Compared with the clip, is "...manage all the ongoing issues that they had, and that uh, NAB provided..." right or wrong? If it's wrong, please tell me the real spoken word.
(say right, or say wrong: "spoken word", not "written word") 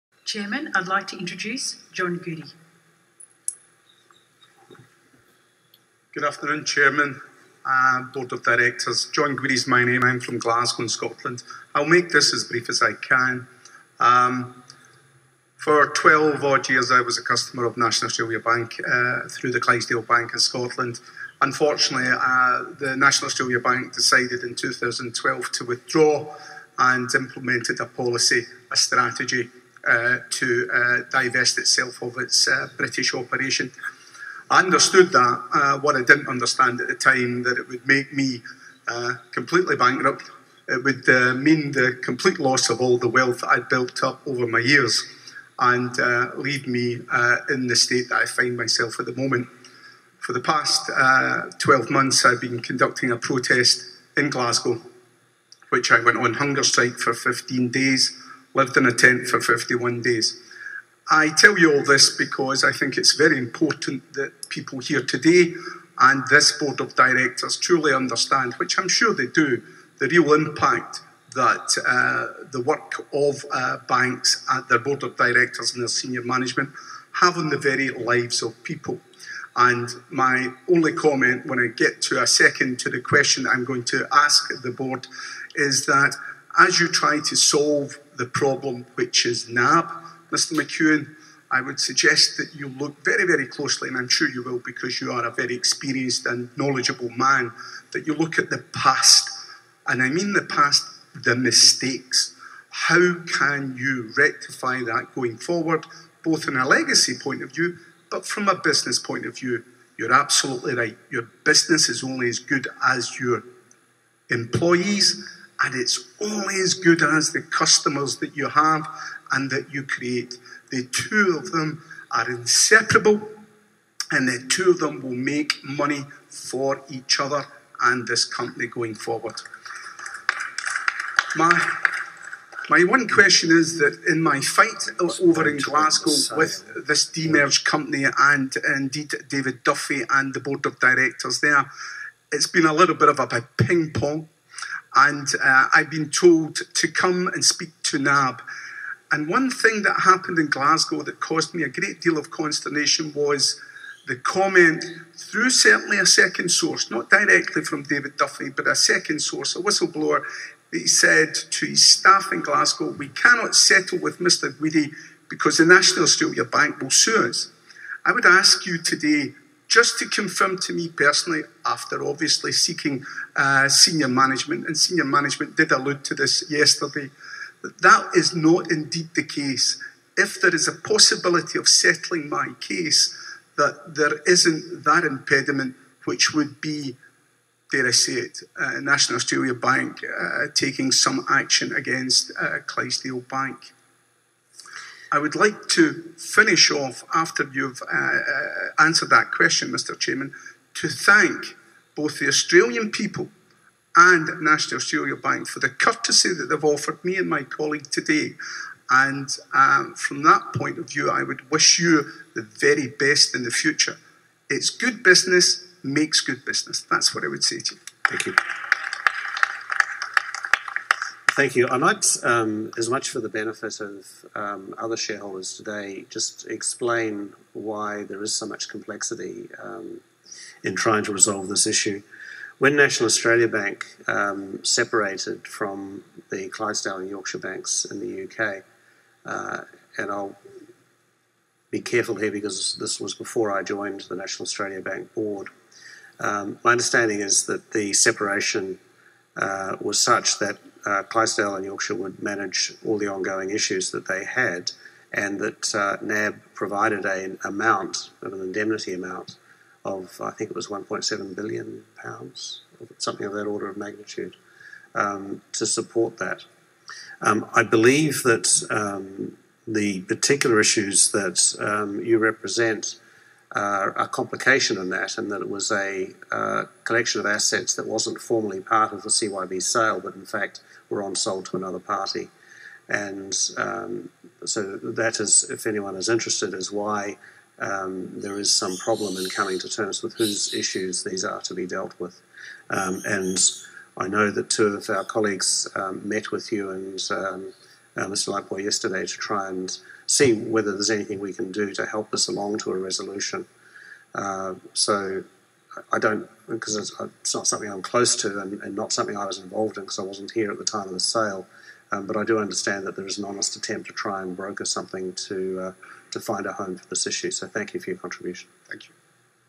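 right.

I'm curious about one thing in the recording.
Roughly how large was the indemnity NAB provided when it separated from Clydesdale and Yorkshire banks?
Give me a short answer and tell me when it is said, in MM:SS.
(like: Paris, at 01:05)
1.7 billion pounds, at 04:20.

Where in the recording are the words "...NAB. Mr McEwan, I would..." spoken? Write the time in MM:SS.
01:29.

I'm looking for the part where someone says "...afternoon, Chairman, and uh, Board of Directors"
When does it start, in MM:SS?
00:06.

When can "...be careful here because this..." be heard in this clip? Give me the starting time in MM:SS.
04:01.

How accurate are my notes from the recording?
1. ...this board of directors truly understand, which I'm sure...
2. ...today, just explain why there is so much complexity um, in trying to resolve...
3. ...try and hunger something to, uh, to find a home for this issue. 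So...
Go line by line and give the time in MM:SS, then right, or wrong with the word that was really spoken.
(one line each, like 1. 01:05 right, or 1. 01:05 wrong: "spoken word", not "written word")
1. 01:06 right
2. 03:45 right
3. 05:13 wrong: "broker", not "hunger".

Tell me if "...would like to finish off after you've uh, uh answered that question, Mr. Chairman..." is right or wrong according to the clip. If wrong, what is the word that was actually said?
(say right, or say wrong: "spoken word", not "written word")
right.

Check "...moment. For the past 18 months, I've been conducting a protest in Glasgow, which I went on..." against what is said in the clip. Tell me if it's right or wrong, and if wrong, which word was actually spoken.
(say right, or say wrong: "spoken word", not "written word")
wrong: "12", not "18".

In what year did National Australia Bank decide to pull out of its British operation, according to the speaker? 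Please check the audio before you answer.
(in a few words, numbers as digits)
2012.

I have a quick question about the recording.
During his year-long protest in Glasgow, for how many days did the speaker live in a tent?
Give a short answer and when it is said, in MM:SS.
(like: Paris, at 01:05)
51, at 00:59.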